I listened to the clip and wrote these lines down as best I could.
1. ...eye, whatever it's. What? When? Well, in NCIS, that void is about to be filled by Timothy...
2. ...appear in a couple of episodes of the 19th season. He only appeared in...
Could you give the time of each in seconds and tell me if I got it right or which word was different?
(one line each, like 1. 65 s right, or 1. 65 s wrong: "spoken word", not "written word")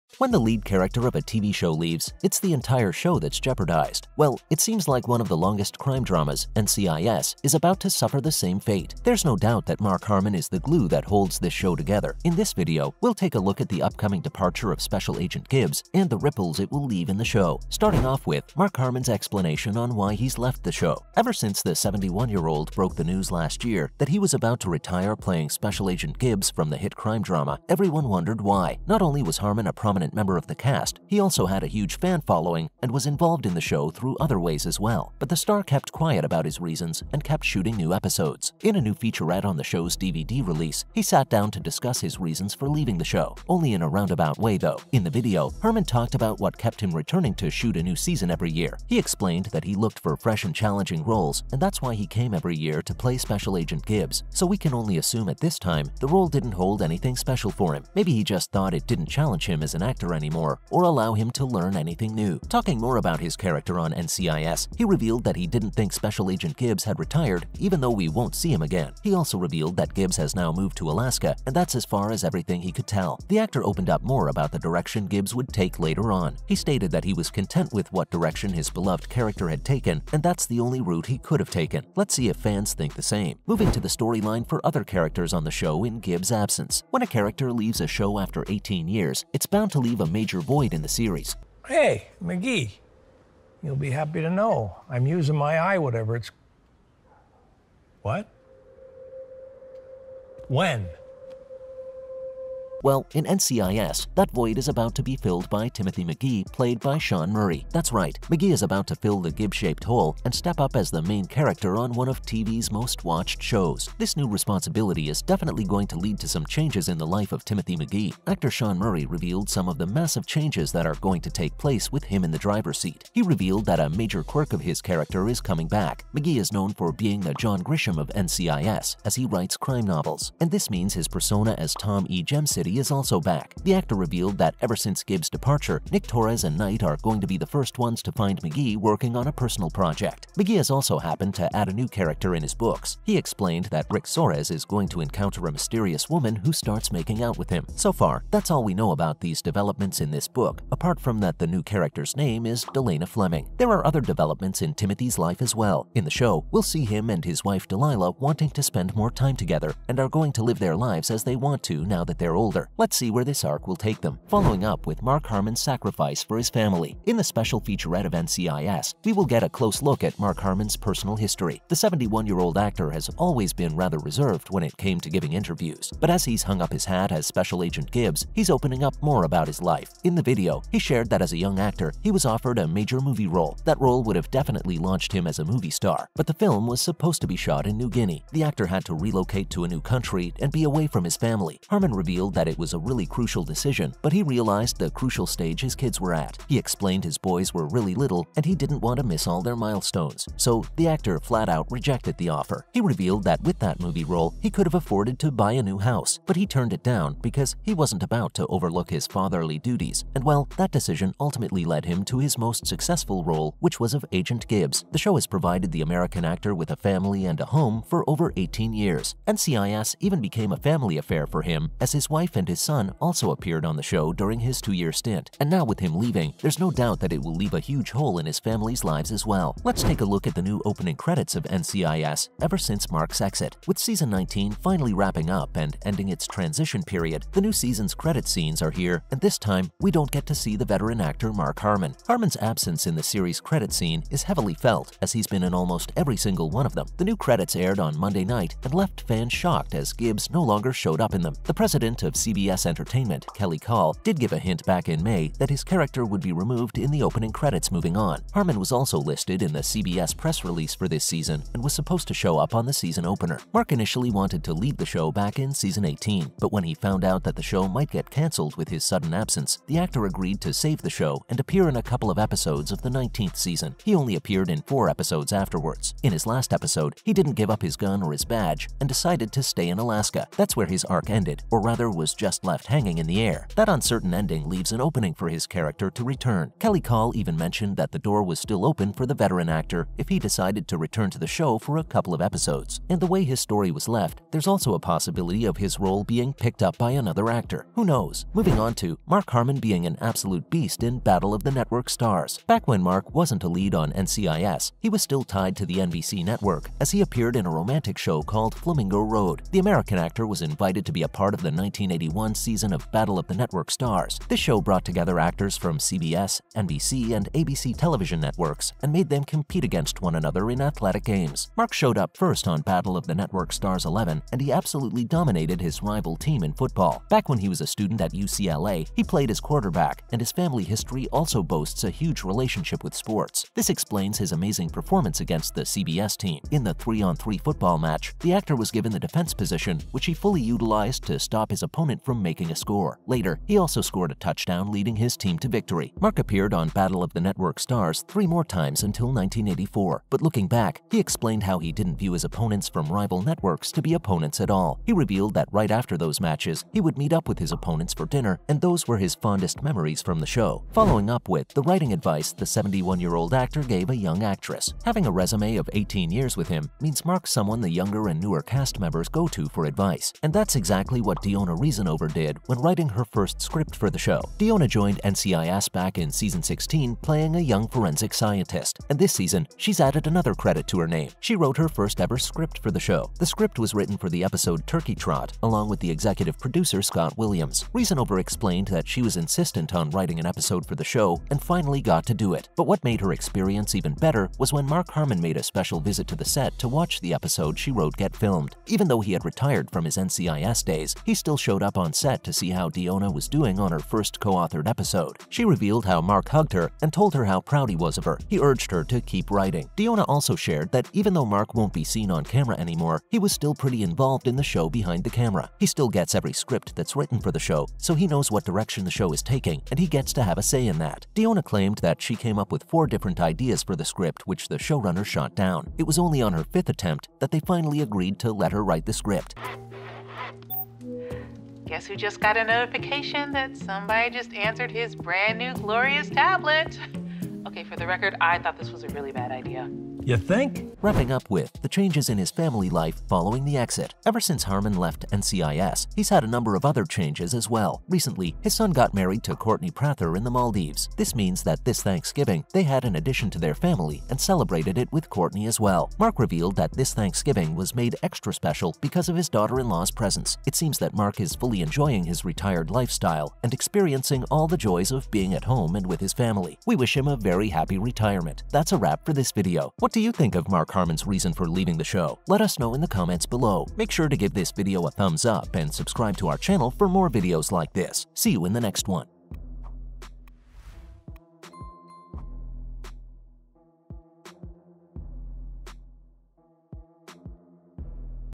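1. 95 s right
2. 271 s right.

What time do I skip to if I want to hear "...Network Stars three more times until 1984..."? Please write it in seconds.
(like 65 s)
347 s.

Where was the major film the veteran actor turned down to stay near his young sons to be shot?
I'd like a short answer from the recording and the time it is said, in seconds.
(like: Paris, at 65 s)
New Guinea, at 187 s.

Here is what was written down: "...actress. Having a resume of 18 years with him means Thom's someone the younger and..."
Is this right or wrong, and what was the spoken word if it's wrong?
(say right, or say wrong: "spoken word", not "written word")
wrong: "Mark", not "Thom".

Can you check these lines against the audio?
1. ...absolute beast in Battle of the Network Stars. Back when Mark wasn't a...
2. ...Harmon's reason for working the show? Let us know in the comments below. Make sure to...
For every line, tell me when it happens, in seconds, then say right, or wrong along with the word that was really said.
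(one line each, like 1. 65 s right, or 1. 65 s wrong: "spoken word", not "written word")
1. 299 s right
2. 470 s wrong: "leaving", not "working".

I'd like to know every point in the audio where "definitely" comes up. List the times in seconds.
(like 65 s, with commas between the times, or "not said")
115 s, 184 s.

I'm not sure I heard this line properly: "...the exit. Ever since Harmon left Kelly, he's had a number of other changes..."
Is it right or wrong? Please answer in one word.
wrong.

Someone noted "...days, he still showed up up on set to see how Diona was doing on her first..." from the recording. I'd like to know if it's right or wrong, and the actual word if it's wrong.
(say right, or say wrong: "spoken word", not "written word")
right.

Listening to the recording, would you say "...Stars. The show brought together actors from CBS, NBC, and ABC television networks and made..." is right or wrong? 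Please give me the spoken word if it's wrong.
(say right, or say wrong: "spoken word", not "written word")
right.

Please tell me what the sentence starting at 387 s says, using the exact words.
Reasonover explained that she was insistent on writing an episode for the show and finally got to do it.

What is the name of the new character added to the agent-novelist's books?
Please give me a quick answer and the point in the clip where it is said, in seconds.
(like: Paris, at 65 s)
Delana Fleming, at 152 s.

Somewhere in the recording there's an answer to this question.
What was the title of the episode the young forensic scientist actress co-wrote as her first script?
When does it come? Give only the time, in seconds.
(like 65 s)
384 s.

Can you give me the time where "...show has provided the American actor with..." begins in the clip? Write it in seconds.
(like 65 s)
214 s.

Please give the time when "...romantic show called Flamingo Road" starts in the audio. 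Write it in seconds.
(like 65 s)
307 s.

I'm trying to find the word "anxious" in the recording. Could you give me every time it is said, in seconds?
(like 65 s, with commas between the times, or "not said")
not said.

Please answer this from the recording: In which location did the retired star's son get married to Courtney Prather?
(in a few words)
the Maldives.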